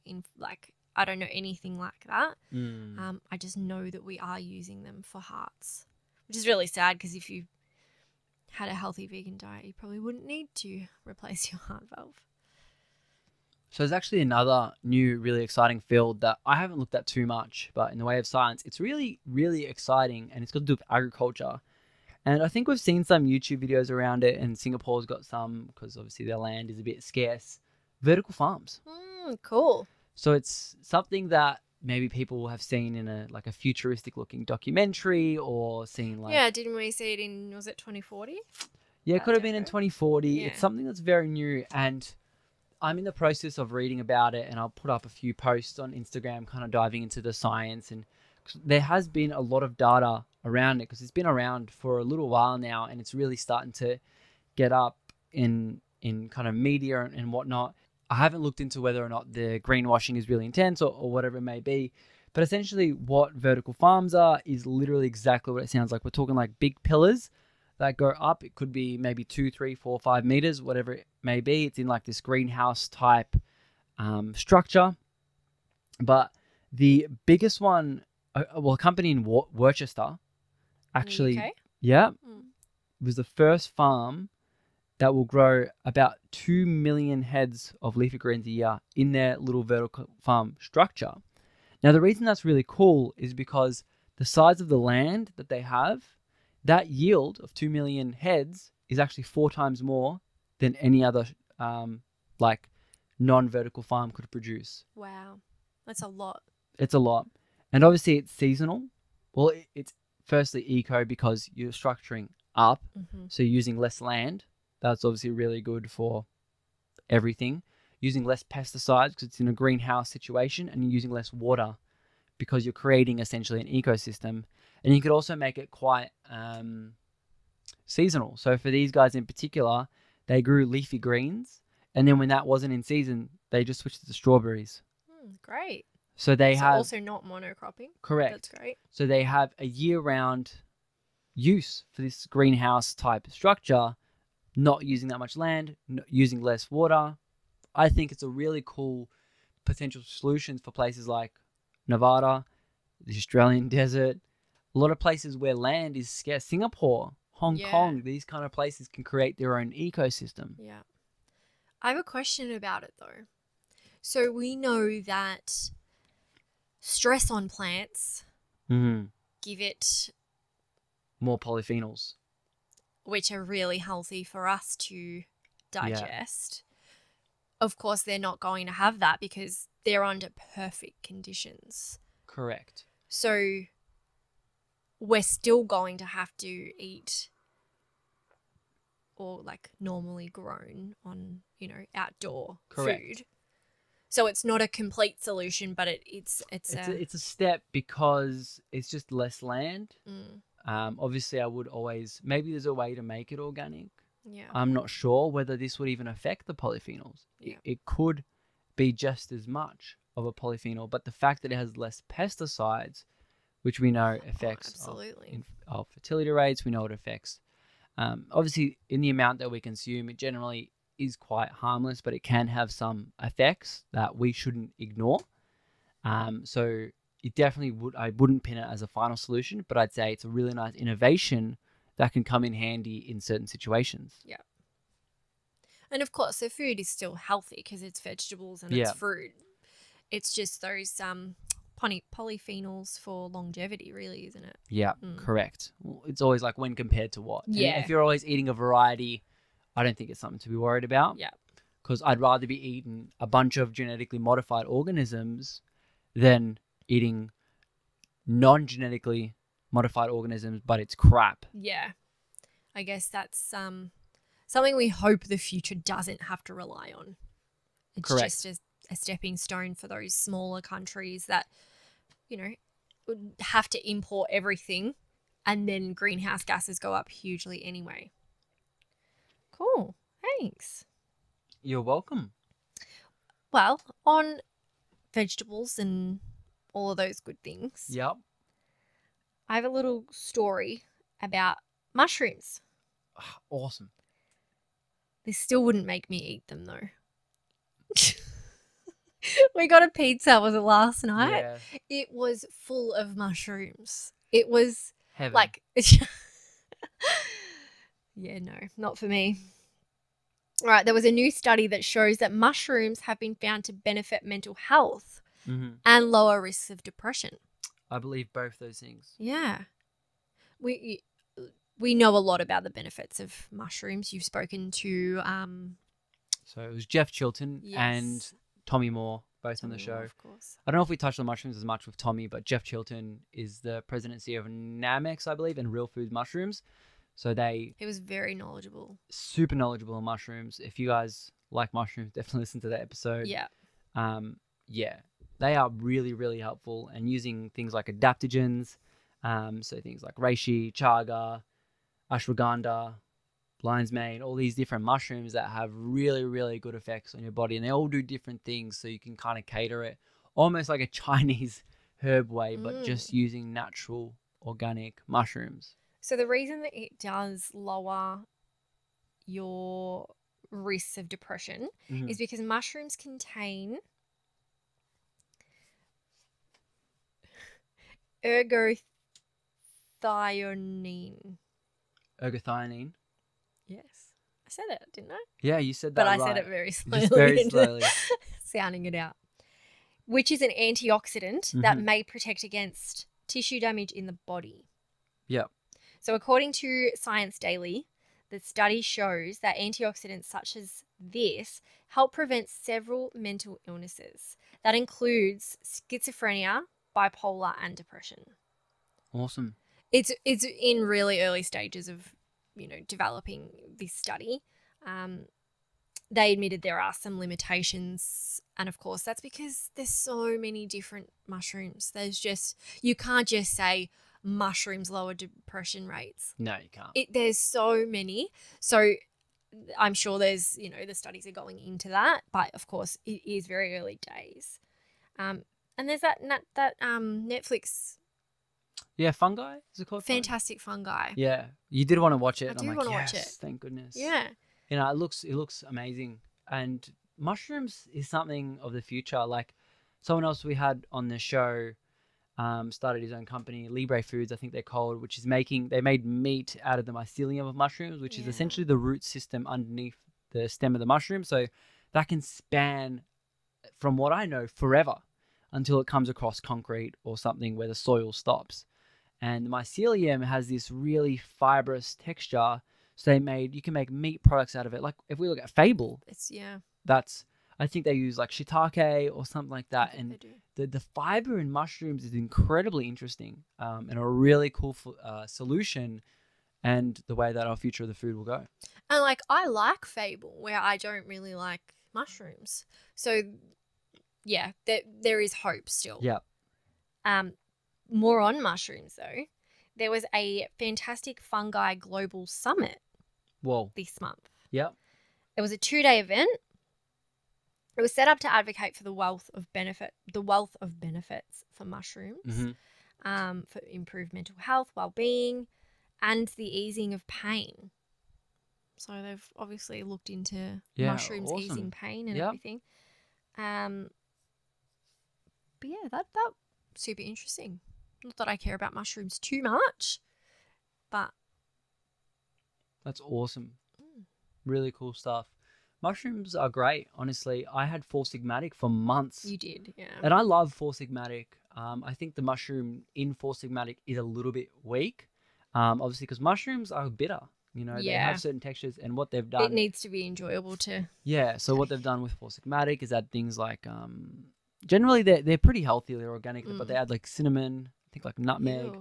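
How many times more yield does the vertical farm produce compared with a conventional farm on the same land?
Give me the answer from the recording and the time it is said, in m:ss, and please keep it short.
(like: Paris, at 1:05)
4, at 1:39.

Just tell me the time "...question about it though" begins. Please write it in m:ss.
2:42.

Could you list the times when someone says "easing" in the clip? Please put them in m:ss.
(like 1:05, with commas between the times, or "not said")
8:36, 8:41.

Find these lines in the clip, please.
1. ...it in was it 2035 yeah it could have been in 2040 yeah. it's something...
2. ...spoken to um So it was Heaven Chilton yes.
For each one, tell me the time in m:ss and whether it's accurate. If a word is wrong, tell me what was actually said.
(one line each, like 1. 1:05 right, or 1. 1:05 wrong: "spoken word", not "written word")
1. 0:37 wrong: "2040", not "2035"
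2. 5:24 wrong: "Jeff", not "Heaven".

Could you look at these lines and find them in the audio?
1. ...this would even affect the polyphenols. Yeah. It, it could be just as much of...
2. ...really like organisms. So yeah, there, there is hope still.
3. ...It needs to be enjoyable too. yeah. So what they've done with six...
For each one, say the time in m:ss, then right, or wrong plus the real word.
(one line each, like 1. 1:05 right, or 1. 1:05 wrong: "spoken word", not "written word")
1. 3:25 right
2. 8:11 wrong: "mushrooms", not "organisms"
3. 9:09 wrong: "four", not "six".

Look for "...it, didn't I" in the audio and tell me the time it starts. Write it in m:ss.
6:24.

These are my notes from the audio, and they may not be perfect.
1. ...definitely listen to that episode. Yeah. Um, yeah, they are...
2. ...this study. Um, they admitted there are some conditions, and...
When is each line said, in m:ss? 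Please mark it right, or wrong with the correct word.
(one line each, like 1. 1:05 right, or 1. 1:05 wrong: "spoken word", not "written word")
1. 5:42 right
2. 6:53 wrong: "limitations", not "conditions".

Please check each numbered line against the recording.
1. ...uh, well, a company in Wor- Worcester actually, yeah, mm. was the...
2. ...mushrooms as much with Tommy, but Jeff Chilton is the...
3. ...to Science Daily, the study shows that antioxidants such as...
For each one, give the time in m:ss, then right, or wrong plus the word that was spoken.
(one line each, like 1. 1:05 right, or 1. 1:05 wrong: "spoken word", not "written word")
1. 1:18 right
2. 5:31 right
3. 6:36 right.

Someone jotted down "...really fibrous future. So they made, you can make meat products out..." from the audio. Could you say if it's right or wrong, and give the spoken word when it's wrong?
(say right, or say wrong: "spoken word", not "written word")
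wrong: "texture", not "future".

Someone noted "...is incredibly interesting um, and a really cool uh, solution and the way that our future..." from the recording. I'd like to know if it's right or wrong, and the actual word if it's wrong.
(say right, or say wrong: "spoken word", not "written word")
right.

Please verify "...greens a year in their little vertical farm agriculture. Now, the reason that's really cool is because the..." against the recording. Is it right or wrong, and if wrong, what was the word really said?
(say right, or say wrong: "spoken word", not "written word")
wrong: "structure", not "agriculture".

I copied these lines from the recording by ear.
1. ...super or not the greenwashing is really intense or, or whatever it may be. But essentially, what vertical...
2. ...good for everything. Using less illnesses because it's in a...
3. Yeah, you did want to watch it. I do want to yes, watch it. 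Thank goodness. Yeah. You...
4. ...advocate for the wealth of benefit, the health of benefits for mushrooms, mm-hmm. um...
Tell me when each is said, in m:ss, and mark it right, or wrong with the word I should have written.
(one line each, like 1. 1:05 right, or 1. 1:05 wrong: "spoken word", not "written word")
1. 0:58 wrong: "whether", not "super"
2. 1:55 wrong: "pesticides", not "illnesses"
3. 7:21 right
4. 8:28 wrong: "wealth", not "health".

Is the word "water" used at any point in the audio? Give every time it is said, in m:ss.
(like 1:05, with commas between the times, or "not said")
2:01, 2:26.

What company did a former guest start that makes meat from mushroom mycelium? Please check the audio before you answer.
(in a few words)
Libre Foods.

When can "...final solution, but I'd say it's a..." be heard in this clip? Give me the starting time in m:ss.
3:48.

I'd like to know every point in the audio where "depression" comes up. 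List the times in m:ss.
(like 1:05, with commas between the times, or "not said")
5:16, 6:11, 6:47, 7:05.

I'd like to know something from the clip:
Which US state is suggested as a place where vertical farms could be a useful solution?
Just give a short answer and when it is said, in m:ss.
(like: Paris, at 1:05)
Nevada, at 2:31.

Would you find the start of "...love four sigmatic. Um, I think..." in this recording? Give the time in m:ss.
9:00.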